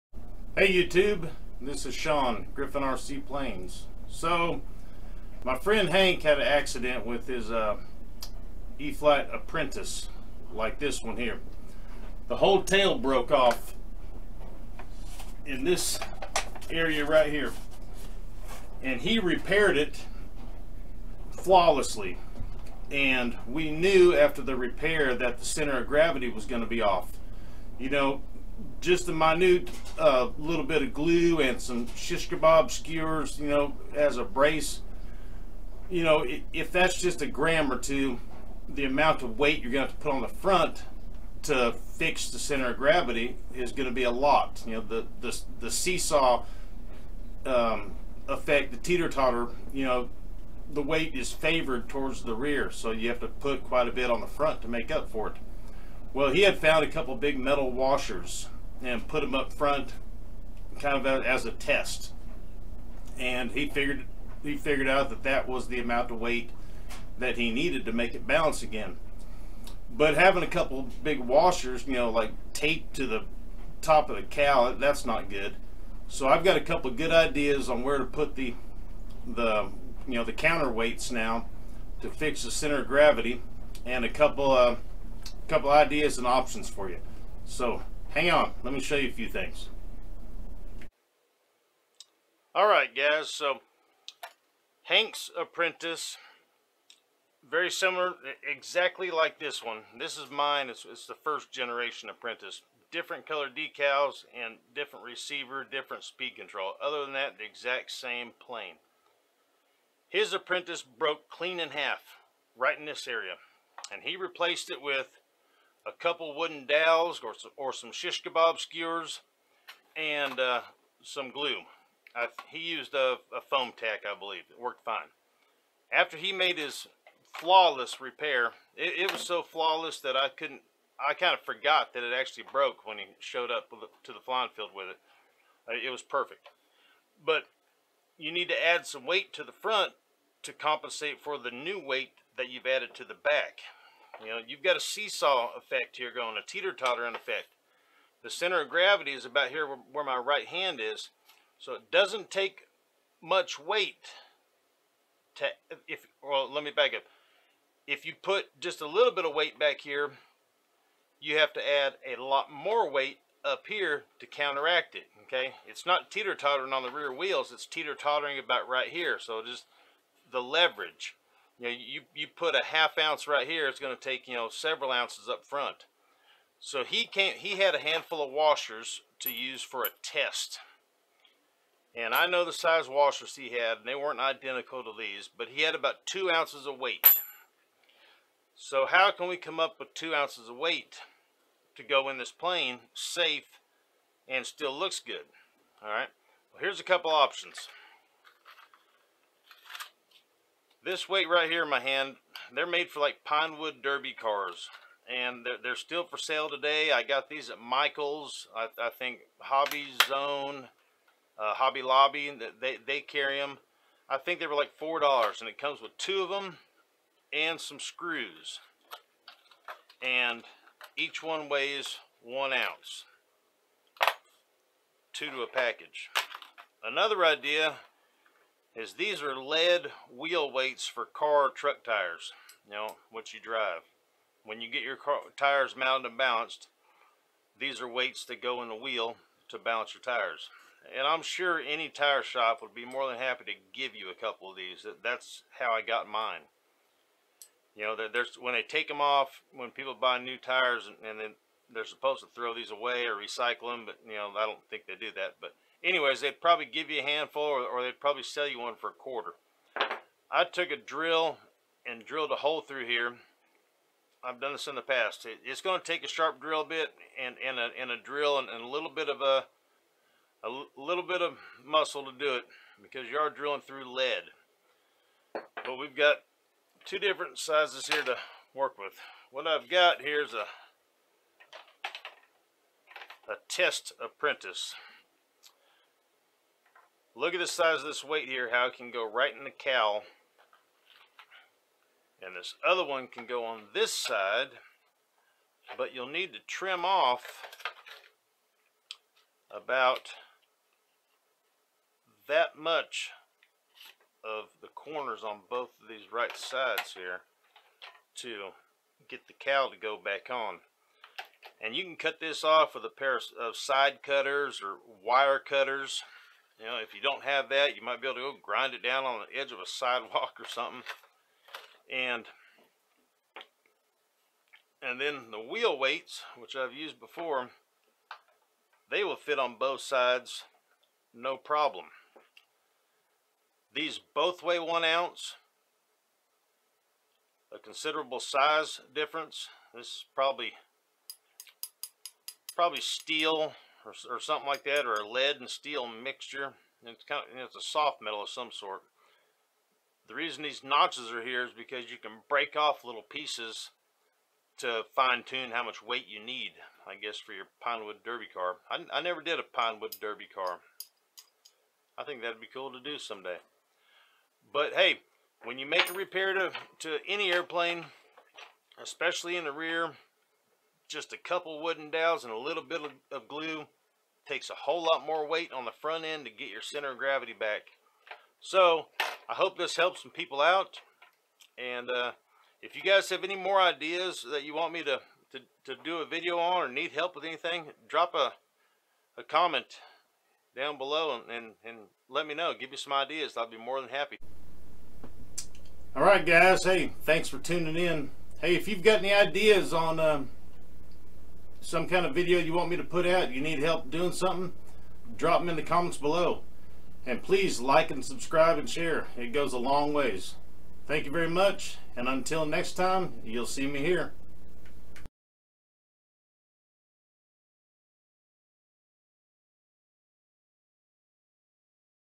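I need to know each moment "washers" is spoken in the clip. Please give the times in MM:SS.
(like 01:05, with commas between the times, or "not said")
00:57, 01:11, 02:58, 03:02.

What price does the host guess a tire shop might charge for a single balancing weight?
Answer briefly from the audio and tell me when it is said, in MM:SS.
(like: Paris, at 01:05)
a quarter, at 04:18.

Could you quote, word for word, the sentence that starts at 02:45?
It's not teeter-tottering on the rear wheels, it's teeter-tottering about right here.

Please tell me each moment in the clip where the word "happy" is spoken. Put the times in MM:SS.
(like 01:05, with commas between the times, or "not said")
04:03, 06:33.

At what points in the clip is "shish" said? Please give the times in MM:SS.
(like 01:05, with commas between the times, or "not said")
00:31, 01:57.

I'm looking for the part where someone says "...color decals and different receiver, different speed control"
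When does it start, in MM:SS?
01:43.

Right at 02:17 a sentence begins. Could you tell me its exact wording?
But you need to add some weight to the front to compensate for the new weight that you've added to the back.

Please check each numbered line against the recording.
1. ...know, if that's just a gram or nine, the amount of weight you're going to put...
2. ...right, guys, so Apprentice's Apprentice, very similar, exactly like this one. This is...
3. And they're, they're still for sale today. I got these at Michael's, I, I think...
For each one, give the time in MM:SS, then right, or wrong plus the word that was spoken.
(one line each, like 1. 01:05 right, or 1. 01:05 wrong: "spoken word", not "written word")
1. 00:36 wrong: "two", not "nine"
2. 01:32 wrong: "Hank", not "Apprentice"
3. 03:25 right.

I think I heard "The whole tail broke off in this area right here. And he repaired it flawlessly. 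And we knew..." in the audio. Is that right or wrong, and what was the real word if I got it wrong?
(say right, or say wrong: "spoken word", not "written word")
right.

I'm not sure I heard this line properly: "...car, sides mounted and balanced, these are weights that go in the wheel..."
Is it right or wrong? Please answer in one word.
wrong.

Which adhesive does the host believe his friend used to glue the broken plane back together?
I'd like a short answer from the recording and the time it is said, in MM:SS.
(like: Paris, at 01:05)
Foam-Tac, at 02:03.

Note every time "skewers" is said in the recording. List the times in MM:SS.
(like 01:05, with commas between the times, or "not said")
00:32, 01:58.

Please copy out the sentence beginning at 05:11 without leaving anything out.
And you can cut this off with a pair of side cutters or wire cutters.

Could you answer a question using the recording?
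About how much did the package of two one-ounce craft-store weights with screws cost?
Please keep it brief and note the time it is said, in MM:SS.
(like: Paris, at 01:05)
$4, at 03:34.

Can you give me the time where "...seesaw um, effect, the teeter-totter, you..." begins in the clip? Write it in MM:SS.
00:45.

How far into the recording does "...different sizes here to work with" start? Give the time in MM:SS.
04:36.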